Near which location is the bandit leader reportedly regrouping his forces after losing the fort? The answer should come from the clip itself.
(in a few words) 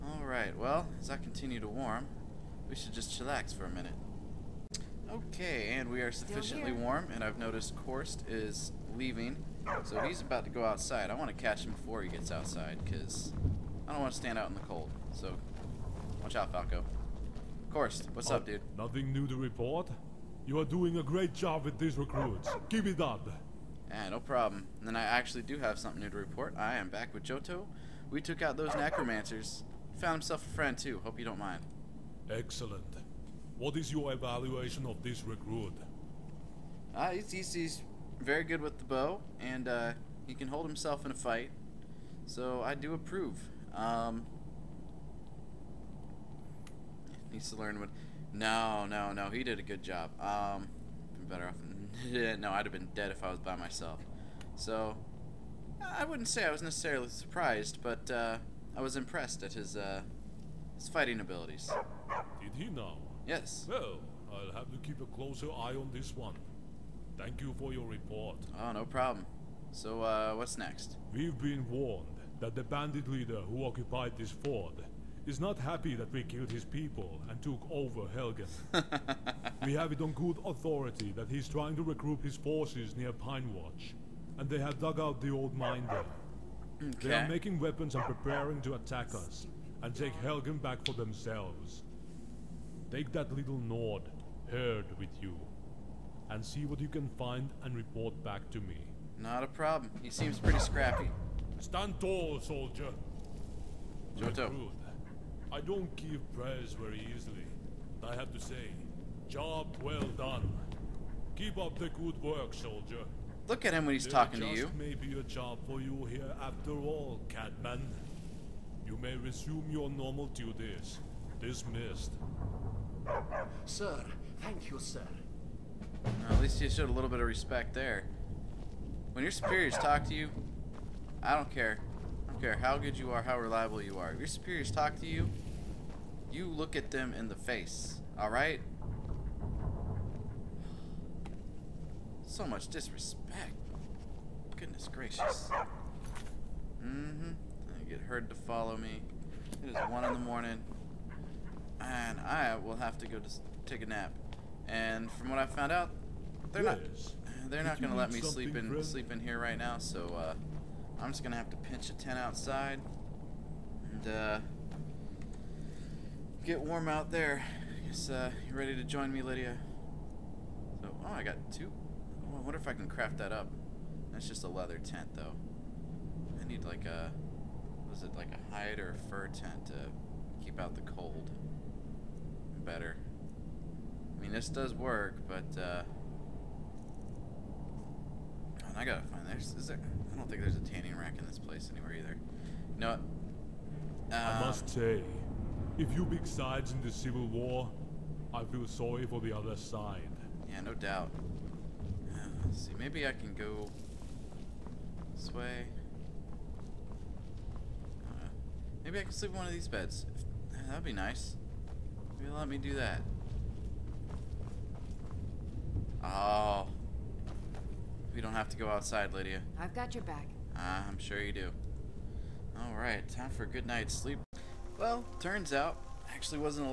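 Pine Watch.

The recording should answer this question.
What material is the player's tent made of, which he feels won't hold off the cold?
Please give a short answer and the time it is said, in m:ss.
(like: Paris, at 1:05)
Leather, at 2:54.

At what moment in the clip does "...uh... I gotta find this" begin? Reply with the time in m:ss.
3:05.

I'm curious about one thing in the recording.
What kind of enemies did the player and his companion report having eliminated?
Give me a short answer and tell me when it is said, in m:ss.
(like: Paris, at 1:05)
Necromancers, at 0:28.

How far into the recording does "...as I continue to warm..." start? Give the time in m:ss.
0:00.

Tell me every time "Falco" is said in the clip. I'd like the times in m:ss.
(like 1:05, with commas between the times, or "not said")
0:16.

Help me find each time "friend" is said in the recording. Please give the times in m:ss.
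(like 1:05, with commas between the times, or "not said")
0:30, 2:38.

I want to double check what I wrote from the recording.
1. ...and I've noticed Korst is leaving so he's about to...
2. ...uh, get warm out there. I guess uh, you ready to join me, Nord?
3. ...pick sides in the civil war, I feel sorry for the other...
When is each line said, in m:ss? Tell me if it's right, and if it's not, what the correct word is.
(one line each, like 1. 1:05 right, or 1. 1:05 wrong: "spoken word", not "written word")
1. 0:07 right
2. 2:44 wrong: "Lydia", not "Nord"
3. 3:16 right.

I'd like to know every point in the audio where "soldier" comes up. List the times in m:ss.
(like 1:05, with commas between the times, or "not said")
1:42, 1:52.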